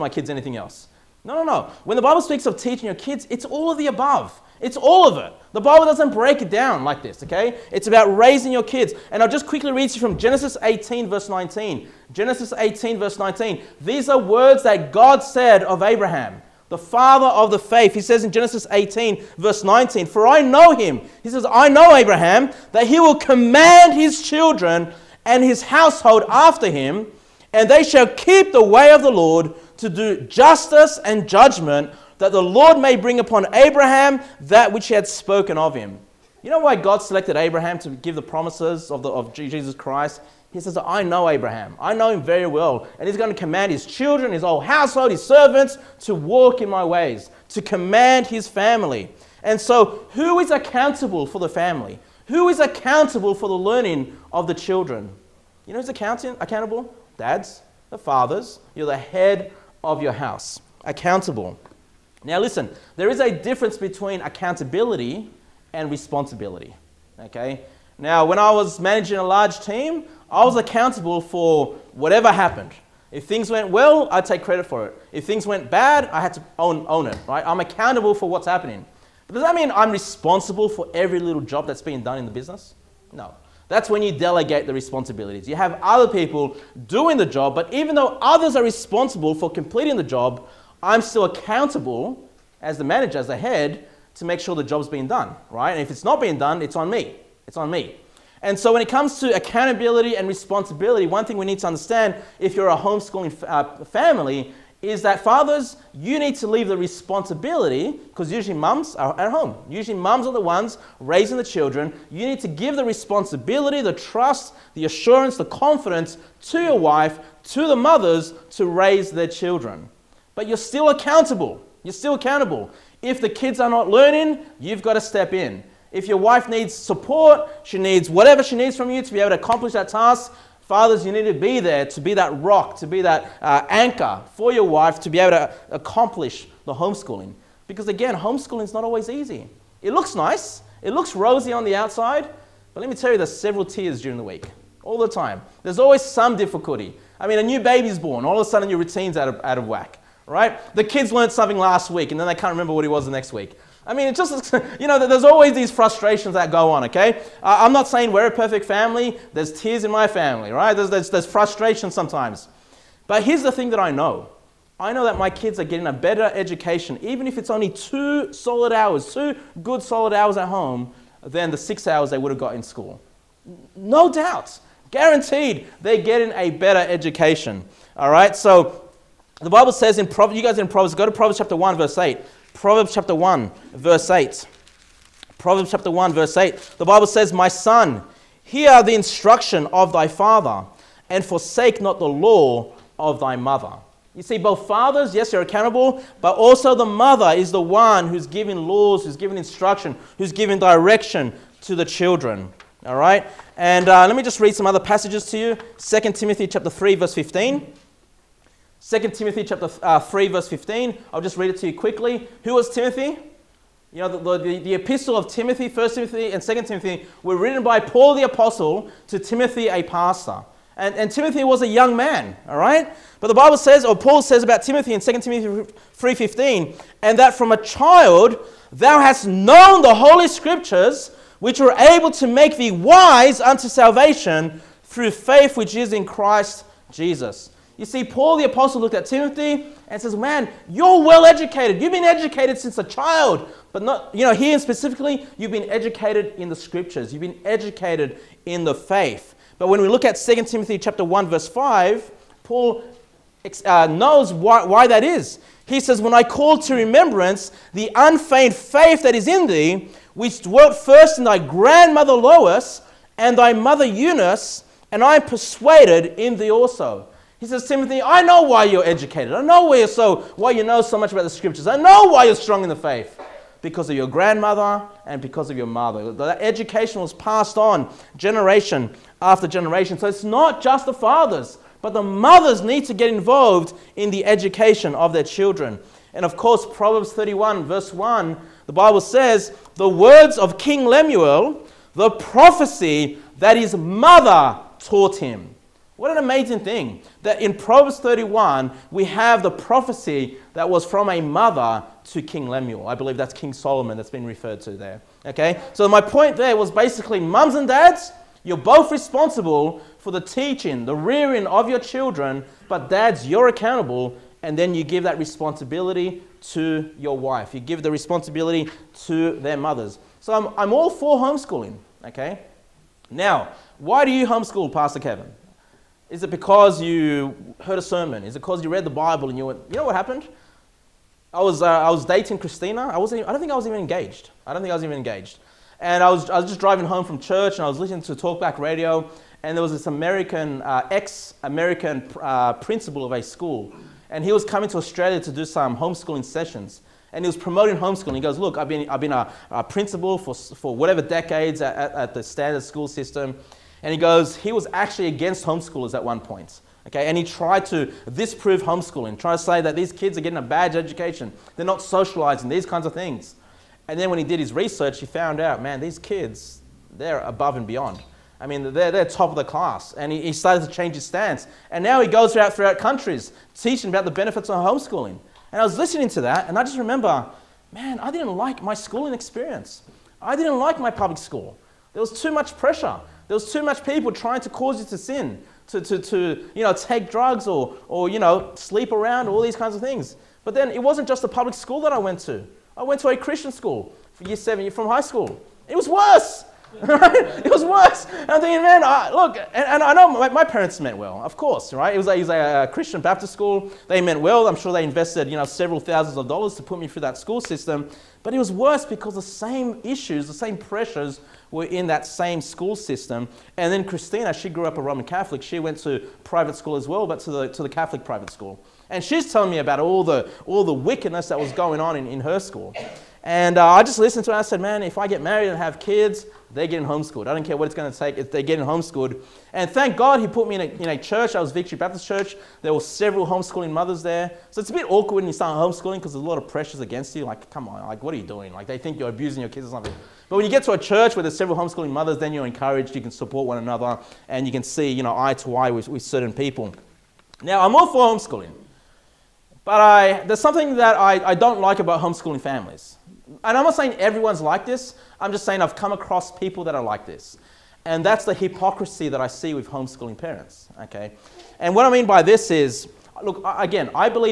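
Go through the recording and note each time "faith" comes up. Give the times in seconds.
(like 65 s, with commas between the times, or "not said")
17 s, 235 s, 248 s, 258 s, 272 s.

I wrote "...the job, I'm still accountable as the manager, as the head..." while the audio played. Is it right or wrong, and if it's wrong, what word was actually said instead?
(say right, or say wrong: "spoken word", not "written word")
right.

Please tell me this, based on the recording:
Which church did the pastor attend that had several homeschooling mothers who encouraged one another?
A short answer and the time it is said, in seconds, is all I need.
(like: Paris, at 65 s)
Victory Baptist Church, at 431 s.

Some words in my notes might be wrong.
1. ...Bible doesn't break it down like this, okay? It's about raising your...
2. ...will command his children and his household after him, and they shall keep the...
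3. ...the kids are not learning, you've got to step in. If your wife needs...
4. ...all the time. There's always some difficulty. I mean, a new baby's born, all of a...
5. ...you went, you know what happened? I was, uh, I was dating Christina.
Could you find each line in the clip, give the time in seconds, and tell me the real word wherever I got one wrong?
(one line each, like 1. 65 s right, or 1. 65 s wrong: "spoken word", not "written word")
1. 5 s right
2. 22 s right
3. 123 s right
4. 144 s right
5. 329 s right.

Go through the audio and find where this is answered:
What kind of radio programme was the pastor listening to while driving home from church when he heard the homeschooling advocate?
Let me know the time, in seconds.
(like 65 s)
338 s.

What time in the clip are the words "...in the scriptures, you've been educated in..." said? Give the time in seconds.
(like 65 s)
246 s.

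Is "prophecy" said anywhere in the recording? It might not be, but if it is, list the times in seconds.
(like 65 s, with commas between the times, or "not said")
292 s, 299 s.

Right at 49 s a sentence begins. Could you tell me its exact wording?
And so, who is accountable for the family?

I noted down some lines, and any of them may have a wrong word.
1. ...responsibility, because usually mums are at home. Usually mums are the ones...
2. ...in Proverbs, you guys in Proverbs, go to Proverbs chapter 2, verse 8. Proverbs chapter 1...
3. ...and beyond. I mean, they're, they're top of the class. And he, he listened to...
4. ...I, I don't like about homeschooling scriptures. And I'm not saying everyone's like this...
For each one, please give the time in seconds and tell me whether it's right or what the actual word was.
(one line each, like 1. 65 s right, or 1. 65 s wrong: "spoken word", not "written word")
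1. 106 s right
2. 179 s wrong: "1", not "2"
3. 367 s wrong: "started", not "listened"
4. 450 s wrong: "families", not "scriptures".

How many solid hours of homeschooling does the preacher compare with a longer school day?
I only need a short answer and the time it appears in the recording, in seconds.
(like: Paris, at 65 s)
2, at 167 s.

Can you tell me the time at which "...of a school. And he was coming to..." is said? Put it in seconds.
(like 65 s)
343 s.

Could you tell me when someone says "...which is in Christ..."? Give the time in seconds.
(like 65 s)
235 s.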